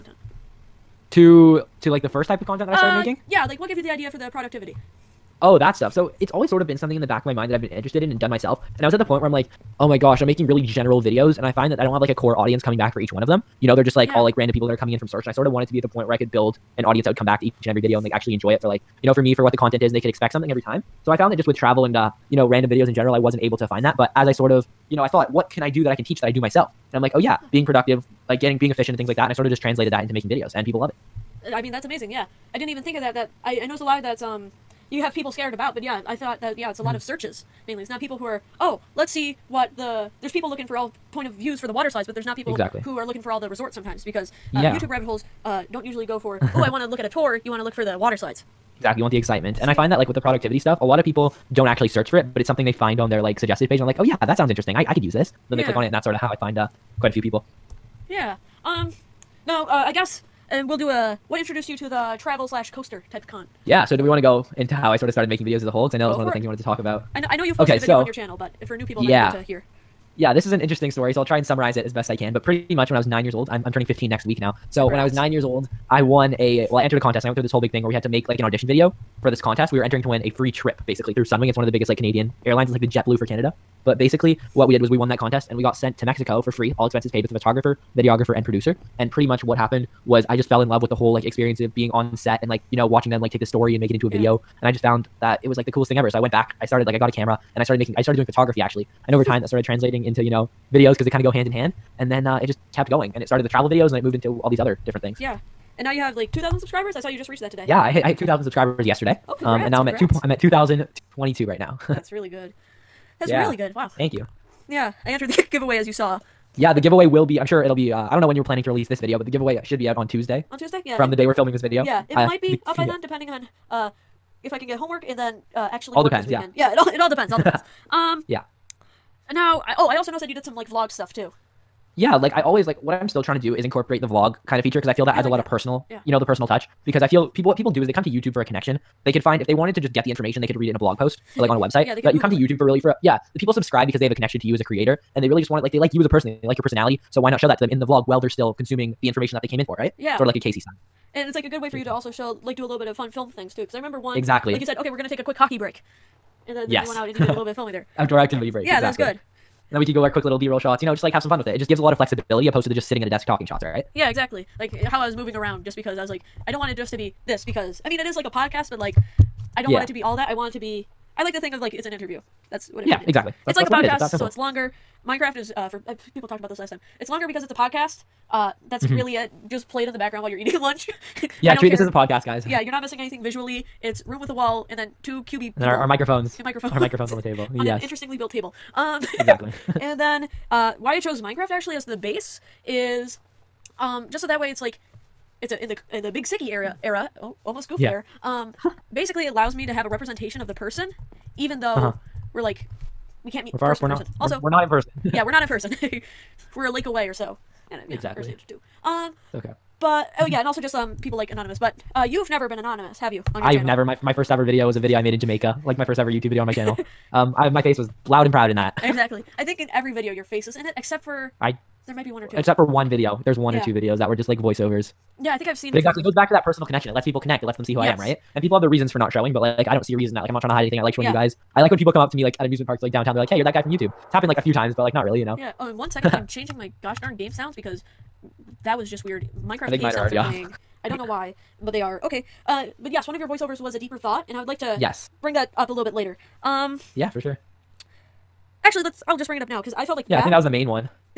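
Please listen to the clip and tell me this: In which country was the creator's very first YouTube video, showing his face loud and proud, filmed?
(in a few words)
Jamaica.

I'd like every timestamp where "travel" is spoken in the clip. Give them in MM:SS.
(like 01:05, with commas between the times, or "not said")
00:21, 01:02, 01:43.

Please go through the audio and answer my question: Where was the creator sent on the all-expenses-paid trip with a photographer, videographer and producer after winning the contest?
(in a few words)
Mexico.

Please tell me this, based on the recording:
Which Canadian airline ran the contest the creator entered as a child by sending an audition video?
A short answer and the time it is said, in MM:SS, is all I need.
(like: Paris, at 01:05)
Sunwing, at 01:21.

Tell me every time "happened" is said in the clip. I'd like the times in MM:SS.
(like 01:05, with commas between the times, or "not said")
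01:29, 03:54.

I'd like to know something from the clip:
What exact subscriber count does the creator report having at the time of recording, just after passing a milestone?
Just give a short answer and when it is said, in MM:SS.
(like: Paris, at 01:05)
2,022, at 01:50.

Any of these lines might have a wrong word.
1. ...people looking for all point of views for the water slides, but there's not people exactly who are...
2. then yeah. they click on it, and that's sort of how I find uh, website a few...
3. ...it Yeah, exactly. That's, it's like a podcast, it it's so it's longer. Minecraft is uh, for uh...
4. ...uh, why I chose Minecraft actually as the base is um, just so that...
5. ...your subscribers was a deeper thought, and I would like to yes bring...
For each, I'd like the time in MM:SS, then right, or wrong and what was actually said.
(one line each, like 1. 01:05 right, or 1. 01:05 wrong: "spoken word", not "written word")
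1. 00:40 right
2. 00:55 wrong: "quite", not "website"
3. 02:52 right
4. 03:10 right
5. 04:03 wrong: "voiceovers", not "subscribers".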